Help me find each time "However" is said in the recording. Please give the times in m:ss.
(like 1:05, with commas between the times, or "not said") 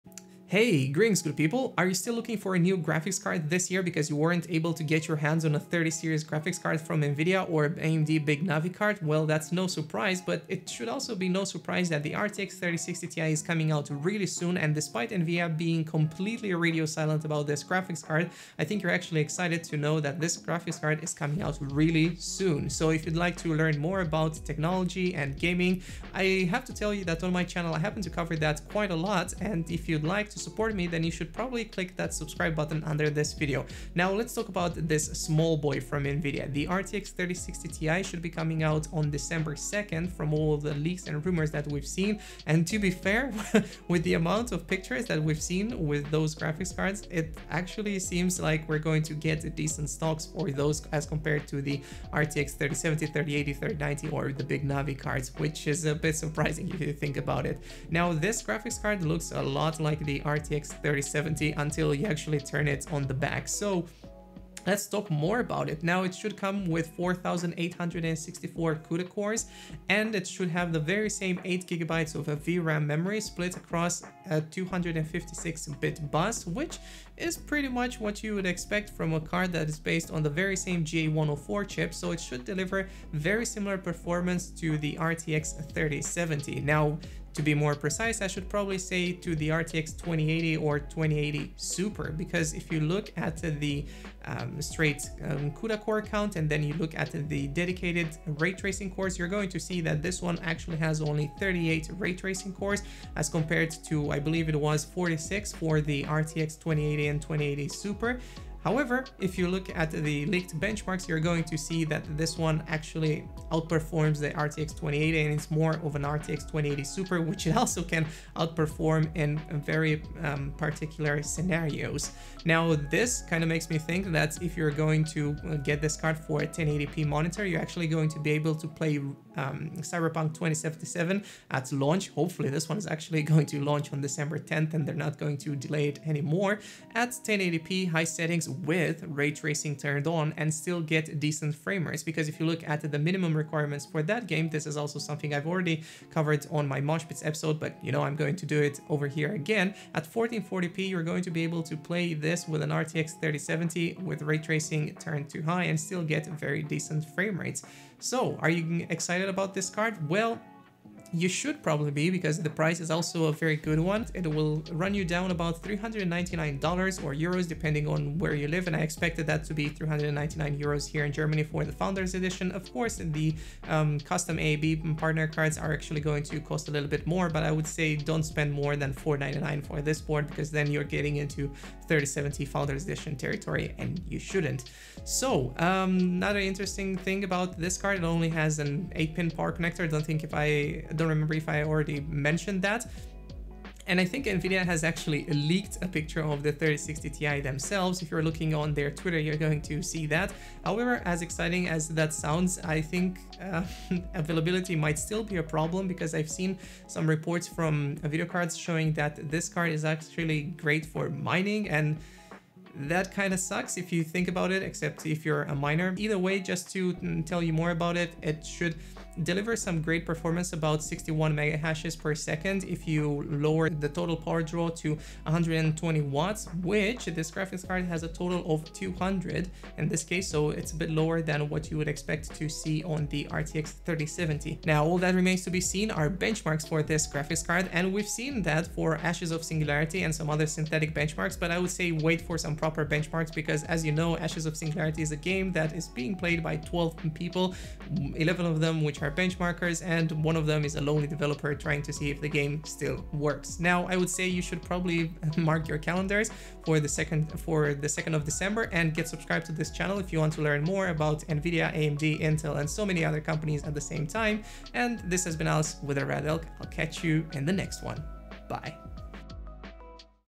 1:48, 3:20.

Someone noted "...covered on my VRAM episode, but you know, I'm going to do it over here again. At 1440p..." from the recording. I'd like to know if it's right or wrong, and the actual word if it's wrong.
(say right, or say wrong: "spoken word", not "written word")
wrong: "Moshpits", not "VRAM".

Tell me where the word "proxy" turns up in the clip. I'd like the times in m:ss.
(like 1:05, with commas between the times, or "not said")
not said.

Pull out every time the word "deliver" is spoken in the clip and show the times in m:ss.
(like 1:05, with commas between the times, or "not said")
1:22, 3:39.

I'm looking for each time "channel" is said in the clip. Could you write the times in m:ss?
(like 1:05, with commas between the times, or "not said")
0:27, 4:19.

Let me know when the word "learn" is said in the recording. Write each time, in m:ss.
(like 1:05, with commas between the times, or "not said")
0:23, 4:20.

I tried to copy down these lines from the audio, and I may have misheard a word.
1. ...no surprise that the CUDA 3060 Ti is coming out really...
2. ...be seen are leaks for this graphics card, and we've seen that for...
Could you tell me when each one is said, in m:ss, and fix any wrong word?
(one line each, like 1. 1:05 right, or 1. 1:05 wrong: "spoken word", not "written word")
1. 0:11 wrong: "RTX", not "CUDA"
2. 3:55 wrong: "benchmarks", not "leaks".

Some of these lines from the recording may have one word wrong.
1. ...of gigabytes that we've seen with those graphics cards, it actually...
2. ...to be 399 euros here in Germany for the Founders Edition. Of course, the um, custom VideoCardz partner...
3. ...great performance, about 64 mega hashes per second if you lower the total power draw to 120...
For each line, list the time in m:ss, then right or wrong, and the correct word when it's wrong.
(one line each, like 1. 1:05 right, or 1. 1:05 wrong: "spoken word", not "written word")
1. 0:44 wrong: "pictures", not "gigabytes"
2. 2:49 wrong: "AIB", not "VideoCardz"
3. 3:39 wrong: "61", not "64".